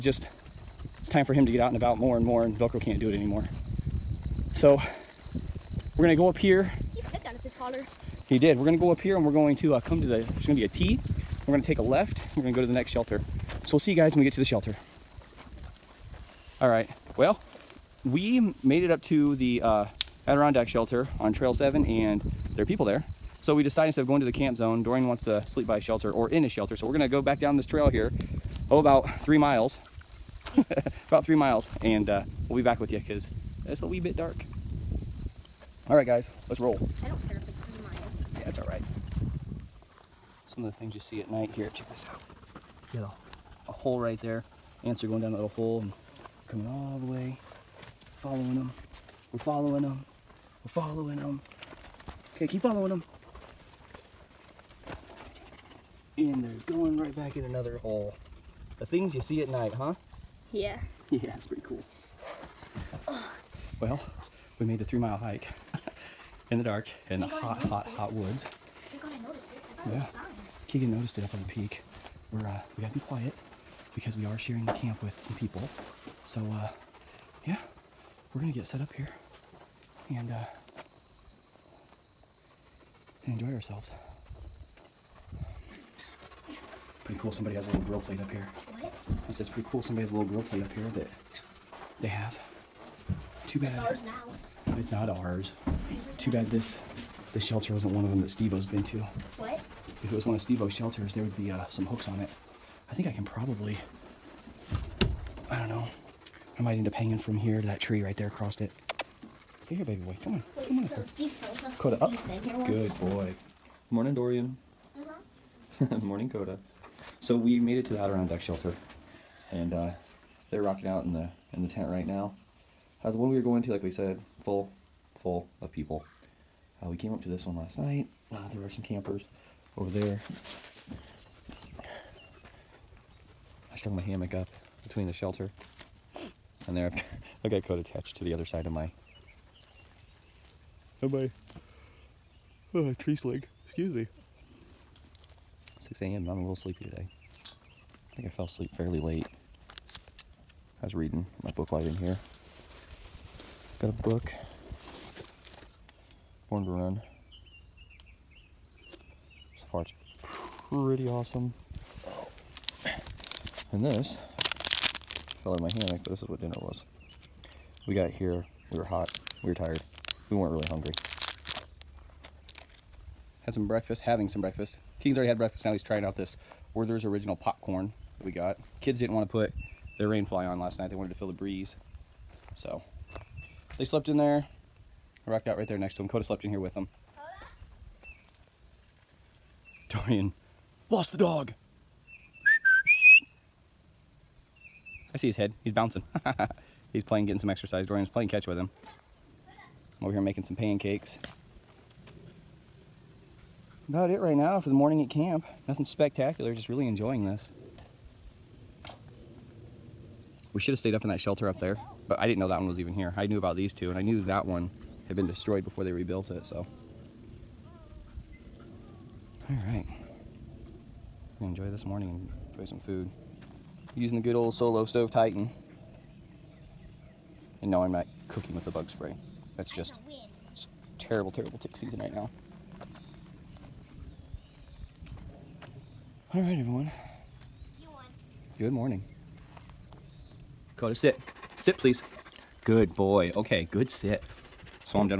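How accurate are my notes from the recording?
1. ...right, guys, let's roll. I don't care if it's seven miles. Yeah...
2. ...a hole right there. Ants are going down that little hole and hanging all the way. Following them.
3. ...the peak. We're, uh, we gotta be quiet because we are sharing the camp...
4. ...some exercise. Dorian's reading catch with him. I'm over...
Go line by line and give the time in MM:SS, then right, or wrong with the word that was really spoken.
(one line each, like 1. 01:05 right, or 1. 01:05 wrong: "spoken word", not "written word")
1. 00:35 wrong: "three", not "seven"
2. 00:43 wrong: "coming", not "hanging"
3. 01:11 right
4. 03:17 wrong: "playing", not "reading".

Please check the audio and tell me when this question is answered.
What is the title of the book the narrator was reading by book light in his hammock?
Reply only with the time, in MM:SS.
02:36.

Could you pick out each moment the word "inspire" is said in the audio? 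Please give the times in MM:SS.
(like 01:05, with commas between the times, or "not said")
not said.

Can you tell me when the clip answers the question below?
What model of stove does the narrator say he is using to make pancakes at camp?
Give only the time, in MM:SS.
03:44.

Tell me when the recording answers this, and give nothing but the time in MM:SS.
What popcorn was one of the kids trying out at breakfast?
02:56.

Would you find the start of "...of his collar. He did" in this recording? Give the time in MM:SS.
00:07.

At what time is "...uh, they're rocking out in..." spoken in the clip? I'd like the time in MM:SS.
01:59.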